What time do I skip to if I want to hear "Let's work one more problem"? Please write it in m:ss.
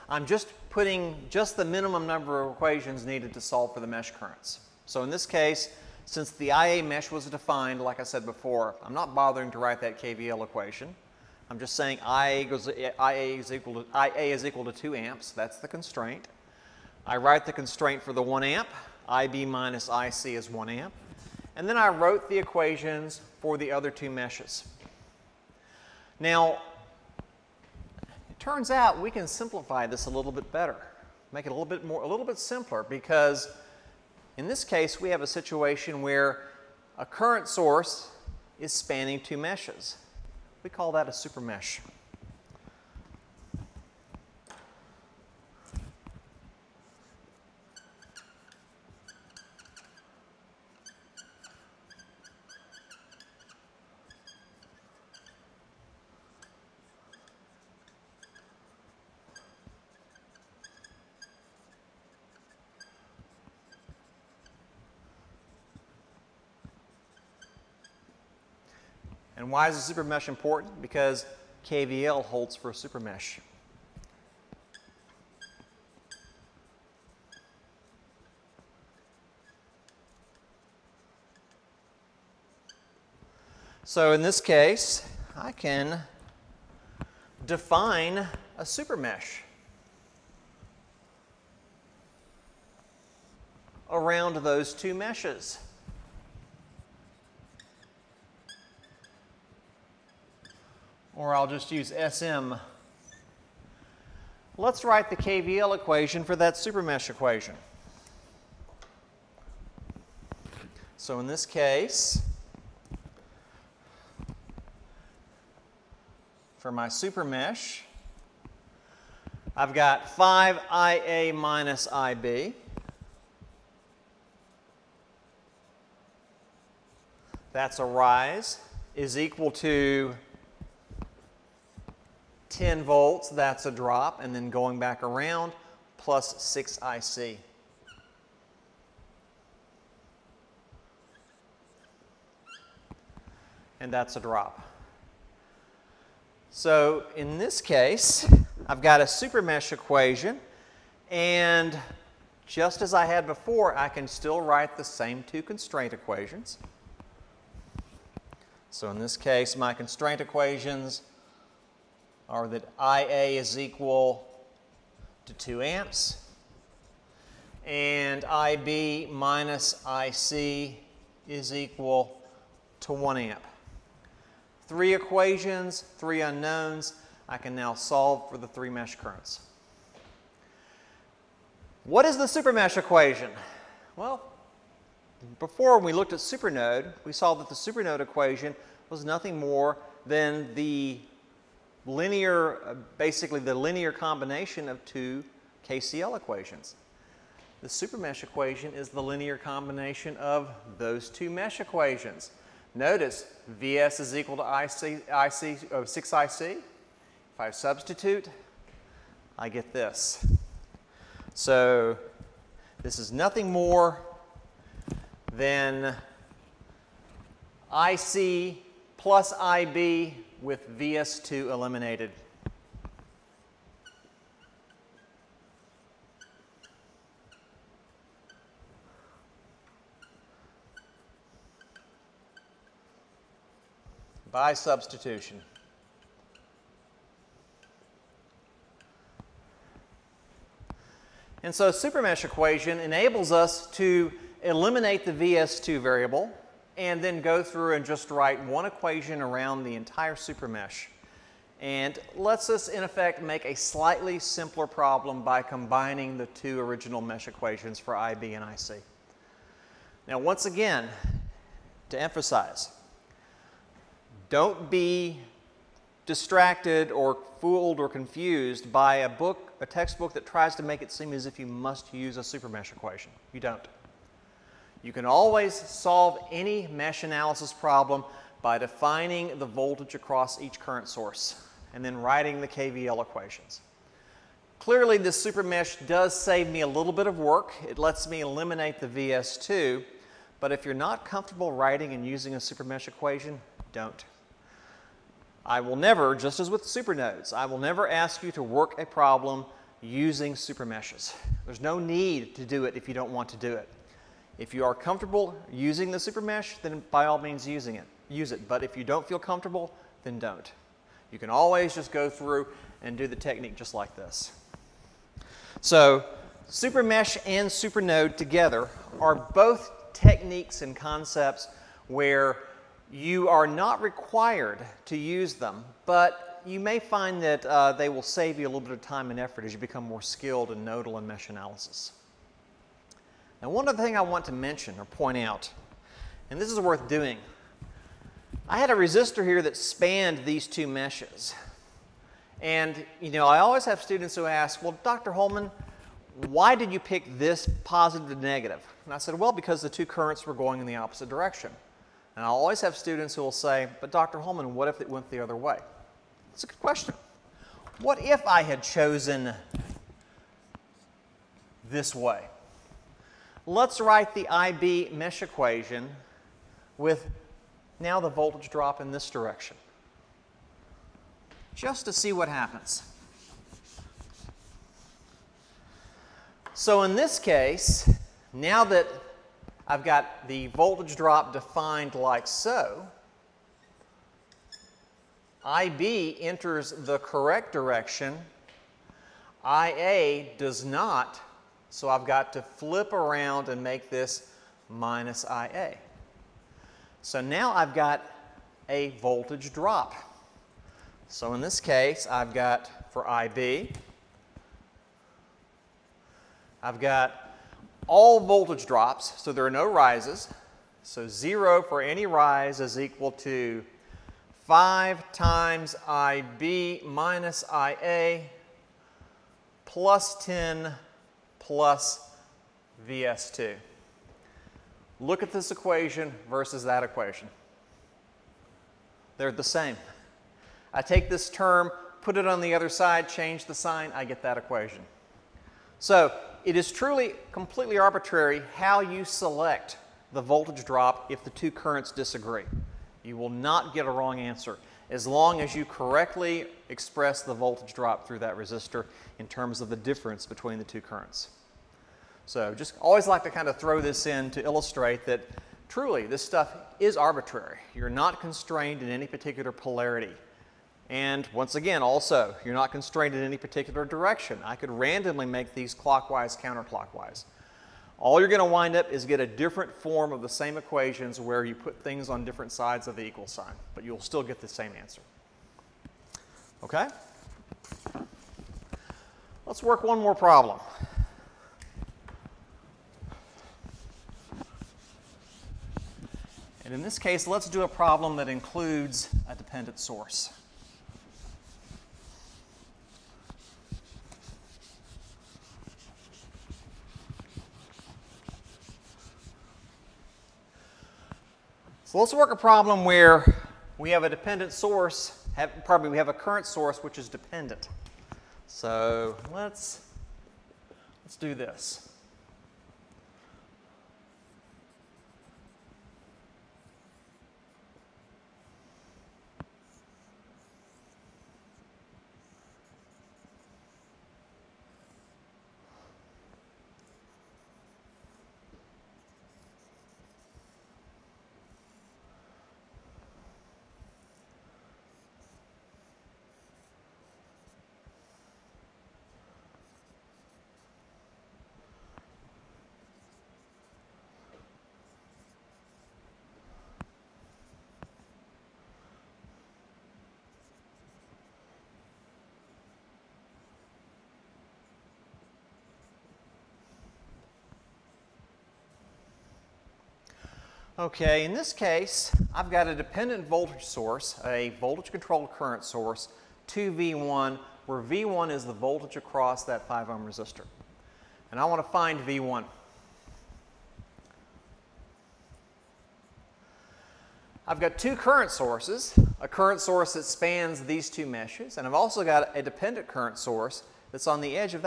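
7:59.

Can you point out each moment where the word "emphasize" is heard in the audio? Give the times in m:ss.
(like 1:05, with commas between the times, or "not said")
4:22.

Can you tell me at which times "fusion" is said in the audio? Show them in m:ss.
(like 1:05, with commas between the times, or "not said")
not said.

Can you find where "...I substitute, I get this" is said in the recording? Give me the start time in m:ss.
3:27.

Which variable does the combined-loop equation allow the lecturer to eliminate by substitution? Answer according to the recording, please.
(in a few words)
VS2.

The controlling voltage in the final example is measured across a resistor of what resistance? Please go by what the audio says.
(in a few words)
5 ohms.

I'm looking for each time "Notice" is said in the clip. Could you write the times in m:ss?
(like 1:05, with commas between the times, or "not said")
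3:22.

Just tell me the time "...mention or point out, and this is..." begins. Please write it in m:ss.
5:34.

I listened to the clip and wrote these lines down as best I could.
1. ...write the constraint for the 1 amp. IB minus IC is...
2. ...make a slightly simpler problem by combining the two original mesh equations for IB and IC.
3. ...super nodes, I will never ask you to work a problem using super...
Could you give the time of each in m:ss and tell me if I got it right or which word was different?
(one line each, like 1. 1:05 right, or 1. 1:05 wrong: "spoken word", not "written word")
1. 0:17 right
2. 4:13 right
3. 4:56 right.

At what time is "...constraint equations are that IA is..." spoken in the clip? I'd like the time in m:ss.
2:39.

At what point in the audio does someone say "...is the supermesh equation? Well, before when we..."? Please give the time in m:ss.
3:02.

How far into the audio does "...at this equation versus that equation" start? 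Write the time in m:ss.
7:05.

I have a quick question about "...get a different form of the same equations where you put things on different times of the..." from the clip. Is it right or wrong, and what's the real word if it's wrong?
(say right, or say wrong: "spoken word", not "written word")
wrong: "sides", not "times".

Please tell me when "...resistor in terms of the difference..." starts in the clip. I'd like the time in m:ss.
7:28.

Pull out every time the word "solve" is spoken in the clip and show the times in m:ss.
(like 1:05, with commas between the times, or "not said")
0:03, 2:57, 4:35.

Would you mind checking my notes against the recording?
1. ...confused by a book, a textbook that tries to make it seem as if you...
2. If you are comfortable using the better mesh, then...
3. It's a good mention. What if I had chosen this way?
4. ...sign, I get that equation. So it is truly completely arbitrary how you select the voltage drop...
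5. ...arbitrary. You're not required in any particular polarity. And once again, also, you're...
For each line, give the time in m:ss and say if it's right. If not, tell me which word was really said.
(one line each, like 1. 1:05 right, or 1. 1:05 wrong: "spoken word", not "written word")
1. 4:27 right
2. 5:04 wrong: "super", not "better"
3. 5:56 wrong: "question", not "mention"
4. 7:13 right
5. 7:36 wrong: "constrained", not "required".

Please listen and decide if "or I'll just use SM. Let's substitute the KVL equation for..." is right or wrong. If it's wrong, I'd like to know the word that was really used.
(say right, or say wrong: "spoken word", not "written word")
wrong: "write", not "substitute".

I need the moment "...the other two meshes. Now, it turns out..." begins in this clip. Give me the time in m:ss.
0:23.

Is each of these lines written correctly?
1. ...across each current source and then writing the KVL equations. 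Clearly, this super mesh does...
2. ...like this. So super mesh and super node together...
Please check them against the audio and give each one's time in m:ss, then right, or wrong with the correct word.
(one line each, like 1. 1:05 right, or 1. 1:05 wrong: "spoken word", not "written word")
1. 4:39 right
2. 5:13 right.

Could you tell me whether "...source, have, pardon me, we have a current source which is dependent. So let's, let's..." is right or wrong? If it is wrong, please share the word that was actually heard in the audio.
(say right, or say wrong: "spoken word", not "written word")
right.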